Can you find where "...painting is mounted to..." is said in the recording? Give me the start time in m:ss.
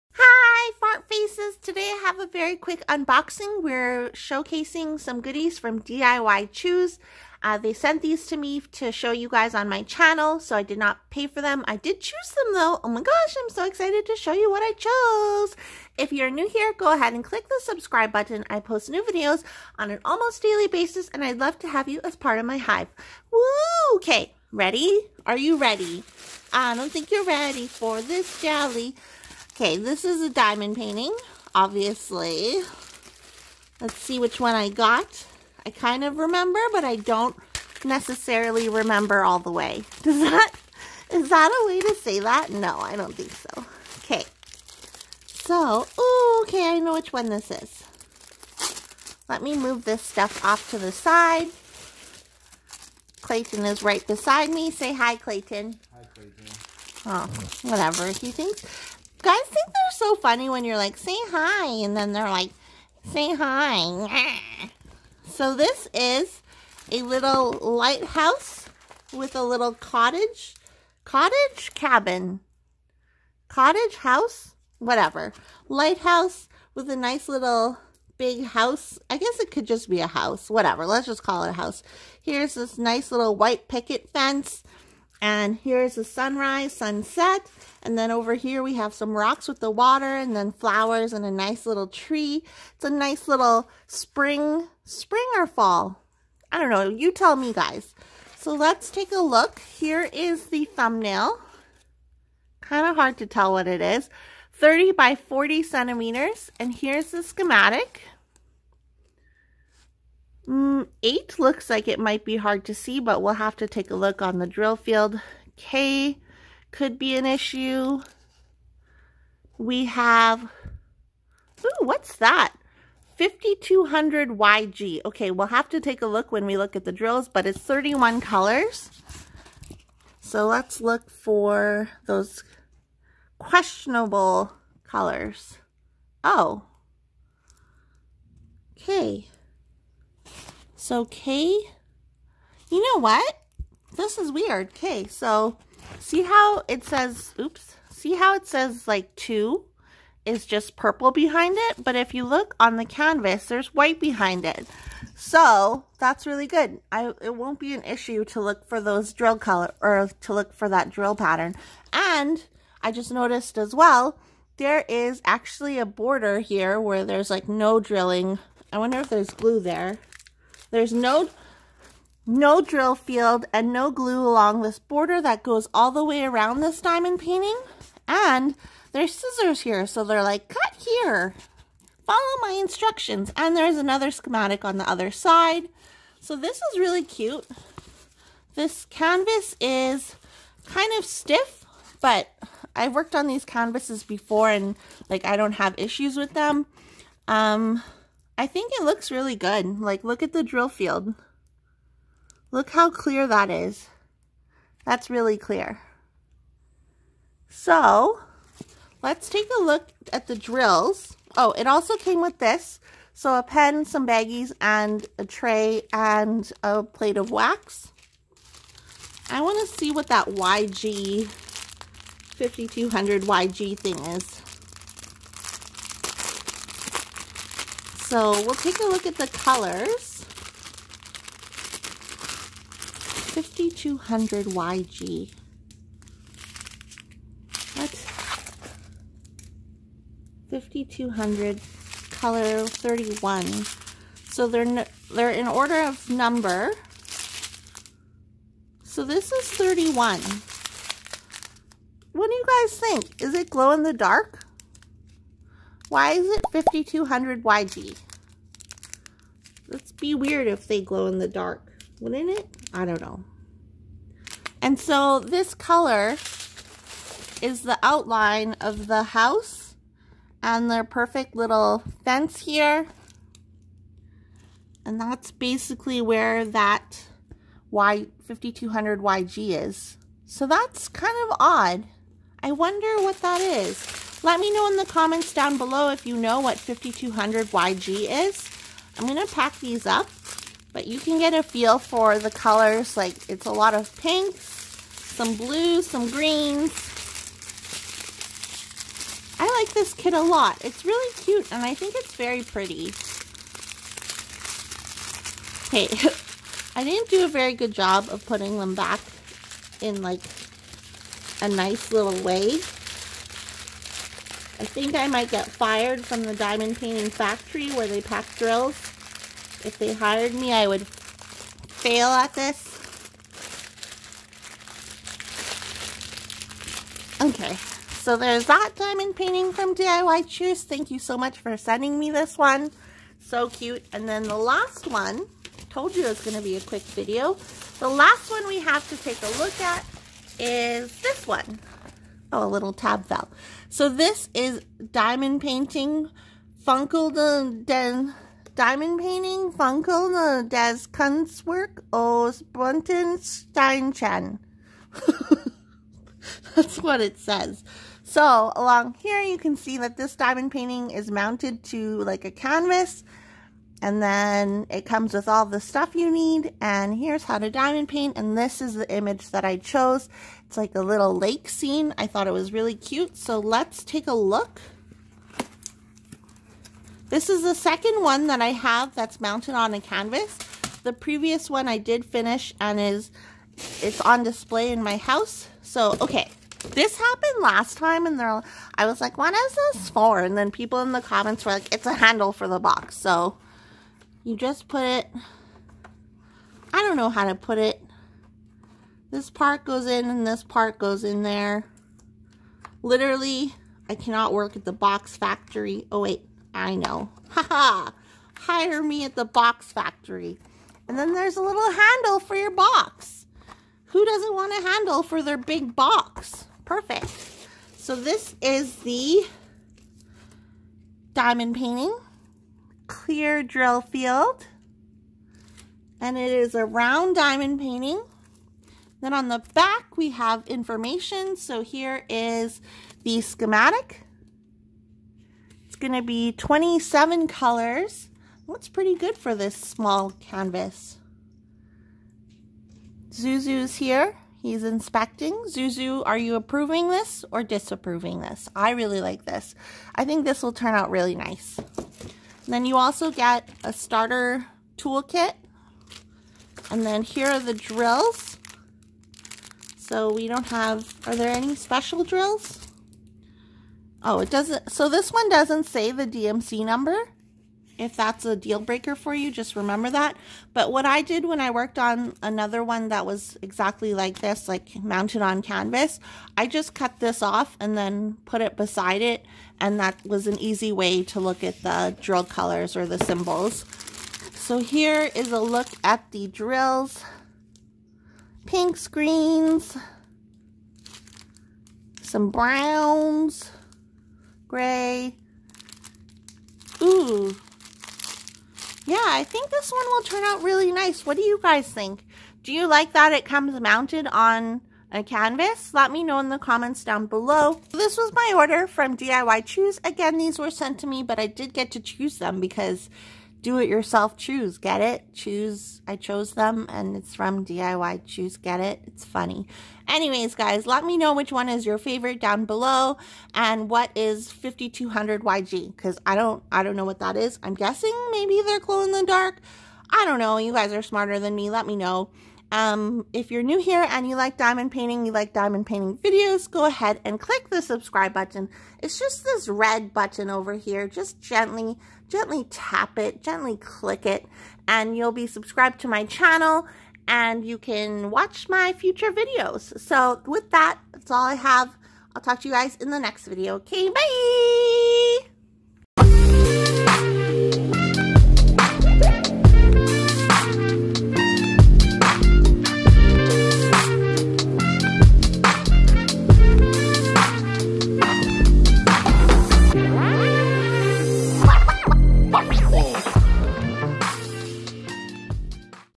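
6:00.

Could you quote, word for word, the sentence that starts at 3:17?
Um, I think it looks really good.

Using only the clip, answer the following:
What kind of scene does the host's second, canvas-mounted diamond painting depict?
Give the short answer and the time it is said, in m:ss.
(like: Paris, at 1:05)
Lake scene, at 6:11.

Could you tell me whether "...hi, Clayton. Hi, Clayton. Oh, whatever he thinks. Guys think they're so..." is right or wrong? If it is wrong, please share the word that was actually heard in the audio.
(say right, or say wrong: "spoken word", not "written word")
right.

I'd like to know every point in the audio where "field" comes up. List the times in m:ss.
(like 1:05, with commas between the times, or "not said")
1:54, 2:52, 3:20, 7:03.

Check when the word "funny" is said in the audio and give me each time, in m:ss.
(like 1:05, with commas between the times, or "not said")
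1:00, 8:39.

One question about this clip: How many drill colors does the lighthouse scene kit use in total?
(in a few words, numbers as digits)
31.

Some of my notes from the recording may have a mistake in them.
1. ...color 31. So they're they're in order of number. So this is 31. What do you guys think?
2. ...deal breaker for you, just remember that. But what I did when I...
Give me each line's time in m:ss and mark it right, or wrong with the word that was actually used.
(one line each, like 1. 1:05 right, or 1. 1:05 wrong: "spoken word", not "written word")
1. 4:02 right
2. 7:48 right.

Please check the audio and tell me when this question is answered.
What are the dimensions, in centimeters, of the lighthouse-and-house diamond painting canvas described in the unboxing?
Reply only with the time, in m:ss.
1:44.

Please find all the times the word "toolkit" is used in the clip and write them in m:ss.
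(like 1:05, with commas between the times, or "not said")
7:34.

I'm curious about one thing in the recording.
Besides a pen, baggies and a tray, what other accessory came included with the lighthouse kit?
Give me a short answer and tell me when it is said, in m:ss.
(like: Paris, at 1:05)
A plate of wax, at 3:36.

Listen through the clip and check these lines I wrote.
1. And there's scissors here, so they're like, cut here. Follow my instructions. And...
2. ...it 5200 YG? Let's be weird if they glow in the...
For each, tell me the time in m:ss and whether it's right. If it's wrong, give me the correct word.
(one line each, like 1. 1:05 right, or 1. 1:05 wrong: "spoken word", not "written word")
1. 2:58 right
2. 4:16 right.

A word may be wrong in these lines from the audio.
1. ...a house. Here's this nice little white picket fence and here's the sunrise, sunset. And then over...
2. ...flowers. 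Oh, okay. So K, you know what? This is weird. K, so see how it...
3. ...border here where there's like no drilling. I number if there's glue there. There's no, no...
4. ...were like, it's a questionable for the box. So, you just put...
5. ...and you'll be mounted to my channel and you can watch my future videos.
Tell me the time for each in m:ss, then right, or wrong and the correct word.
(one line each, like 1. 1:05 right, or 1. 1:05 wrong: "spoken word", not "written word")
1. 1:21 right
2. 2:14 wrong: "colors", not "flowers"
3. 2:45 wrong: "wonder", not "number"
4. 6:31 wrong: "handle", not "questionable"
5. 9:04 wrong: "subscribed", not "mounted".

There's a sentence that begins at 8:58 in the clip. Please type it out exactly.
It's just this red button over here.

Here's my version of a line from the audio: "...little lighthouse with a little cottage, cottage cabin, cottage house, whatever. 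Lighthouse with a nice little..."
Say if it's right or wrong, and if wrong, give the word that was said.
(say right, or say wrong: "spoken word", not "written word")
right.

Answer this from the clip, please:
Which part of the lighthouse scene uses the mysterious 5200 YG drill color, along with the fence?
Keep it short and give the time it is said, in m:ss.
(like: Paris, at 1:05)
Outline of the house, at 4:27.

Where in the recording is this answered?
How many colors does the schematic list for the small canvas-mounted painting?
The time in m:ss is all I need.
7:16.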